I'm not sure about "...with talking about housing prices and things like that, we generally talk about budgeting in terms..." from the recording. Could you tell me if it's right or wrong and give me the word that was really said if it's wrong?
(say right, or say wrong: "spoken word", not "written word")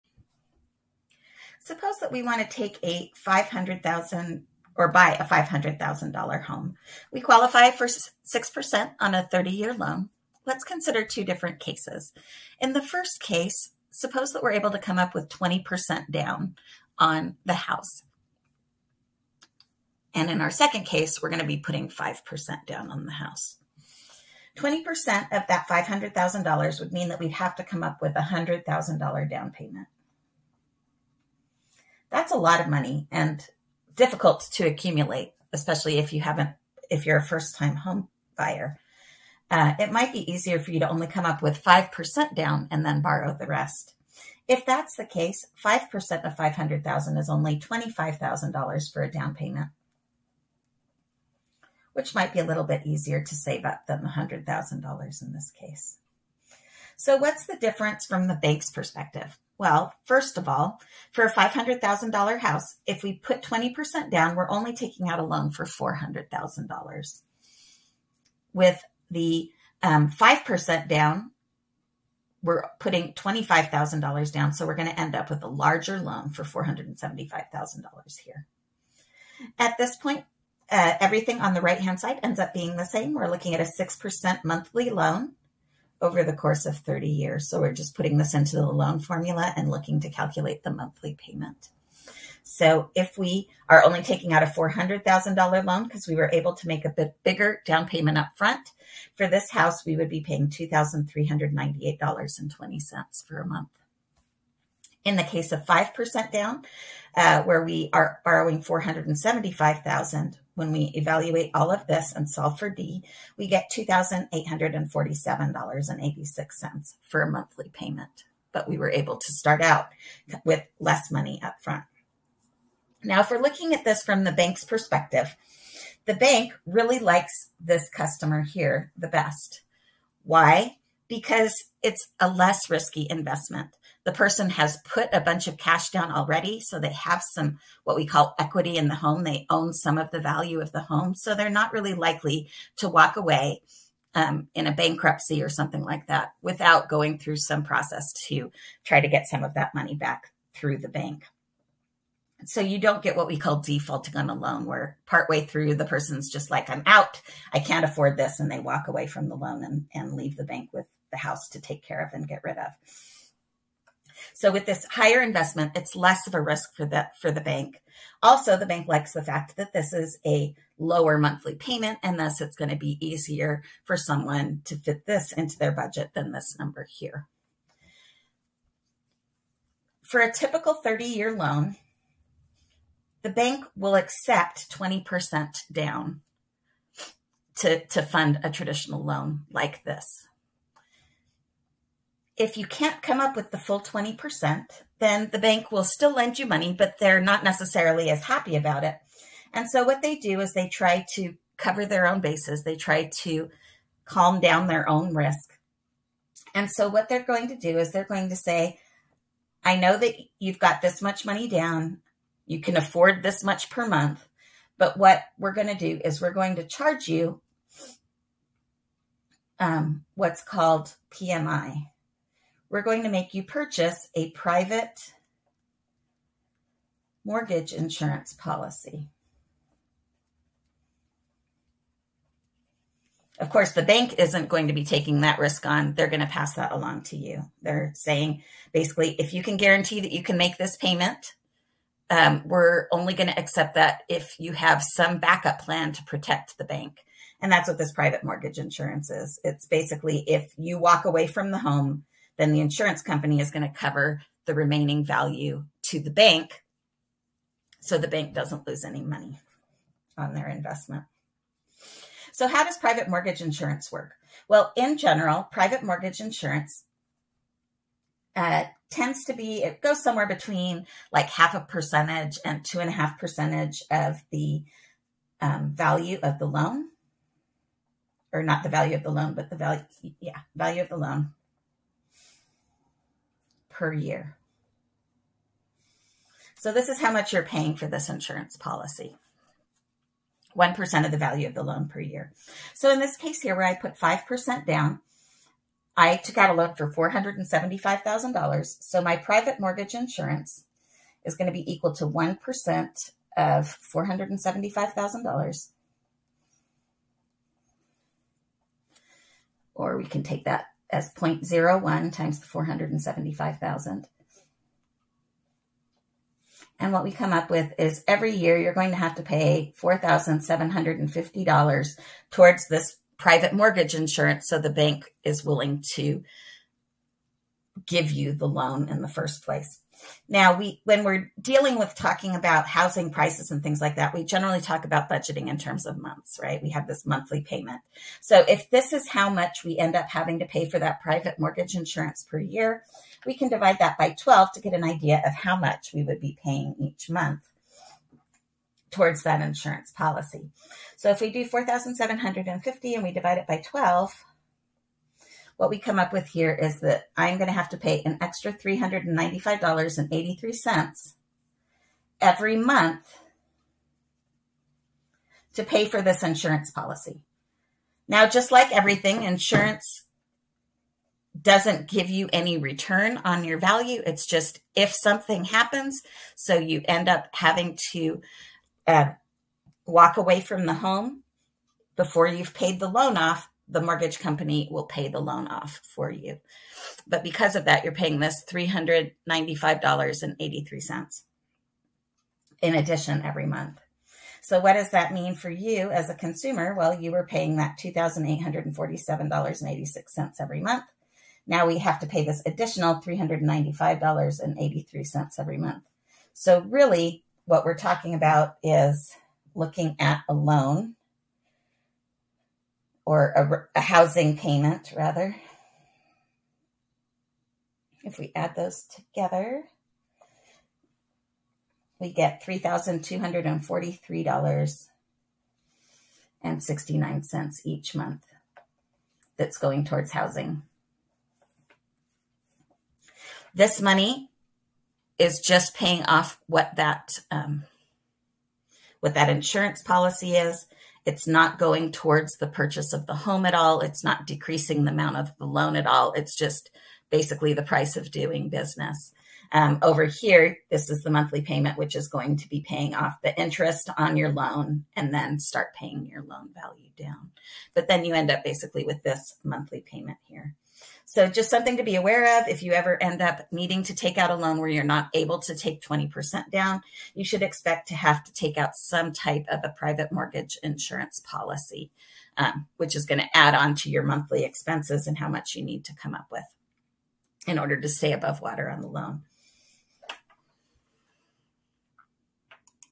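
right.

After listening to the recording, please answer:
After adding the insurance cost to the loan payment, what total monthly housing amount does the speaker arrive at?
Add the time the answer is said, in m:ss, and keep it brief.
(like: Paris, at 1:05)
$3,243.69, at 7:02.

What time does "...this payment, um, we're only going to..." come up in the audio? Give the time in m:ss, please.
4:00.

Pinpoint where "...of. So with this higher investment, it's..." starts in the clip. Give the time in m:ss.
2:42.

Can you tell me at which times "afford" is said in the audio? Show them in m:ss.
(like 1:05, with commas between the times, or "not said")
2:37, 3:32.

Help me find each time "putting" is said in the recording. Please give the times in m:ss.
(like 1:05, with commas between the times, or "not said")
0:21, 1:12, 1:27.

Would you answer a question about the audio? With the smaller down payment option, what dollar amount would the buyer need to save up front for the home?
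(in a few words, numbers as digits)
$25,000.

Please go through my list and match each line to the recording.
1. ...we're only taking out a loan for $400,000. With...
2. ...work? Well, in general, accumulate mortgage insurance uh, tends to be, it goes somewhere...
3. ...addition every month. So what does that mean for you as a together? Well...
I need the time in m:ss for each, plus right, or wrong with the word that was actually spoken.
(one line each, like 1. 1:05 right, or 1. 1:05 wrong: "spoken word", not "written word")
1. 1:04 right
2. 4:23 wrong: "private", not "accumulate"
3. 6:32 wrong: "consumer", not "together".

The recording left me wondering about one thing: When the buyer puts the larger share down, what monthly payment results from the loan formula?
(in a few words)
$2,398.20.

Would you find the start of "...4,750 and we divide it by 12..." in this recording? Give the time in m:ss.
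5:51.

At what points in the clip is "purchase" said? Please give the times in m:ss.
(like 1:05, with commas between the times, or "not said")
3:43, 7:22.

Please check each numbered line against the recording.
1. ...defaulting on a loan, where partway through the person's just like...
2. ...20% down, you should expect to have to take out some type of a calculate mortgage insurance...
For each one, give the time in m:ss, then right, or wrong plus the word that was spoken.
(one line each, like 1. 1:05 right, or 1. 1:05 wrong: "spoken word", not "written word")
1. 2:33 right
2. 7:45 wrong: "private", not "calculate".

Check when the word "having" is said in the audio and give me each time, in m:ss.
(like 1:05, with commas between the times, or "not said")
5:40, 6:17.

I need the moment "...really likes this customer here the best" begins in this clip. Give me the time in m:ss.
2:06.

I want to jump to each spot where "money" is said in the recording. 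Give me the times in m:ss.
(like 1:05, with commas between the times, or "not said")
0:32, 2:01, 2:29, 3:16, 3:31, 4:19, 7:13.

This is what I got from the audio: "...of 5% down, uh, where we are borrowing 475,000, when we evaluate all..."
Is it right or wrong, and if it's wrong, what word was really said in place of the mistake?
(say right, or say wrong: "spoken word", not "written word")
right.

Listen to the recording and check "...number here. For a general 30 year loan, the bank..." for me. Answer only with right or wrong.
wrong.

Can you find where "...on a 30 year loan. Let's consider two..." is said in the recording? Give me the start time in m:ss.
0:08.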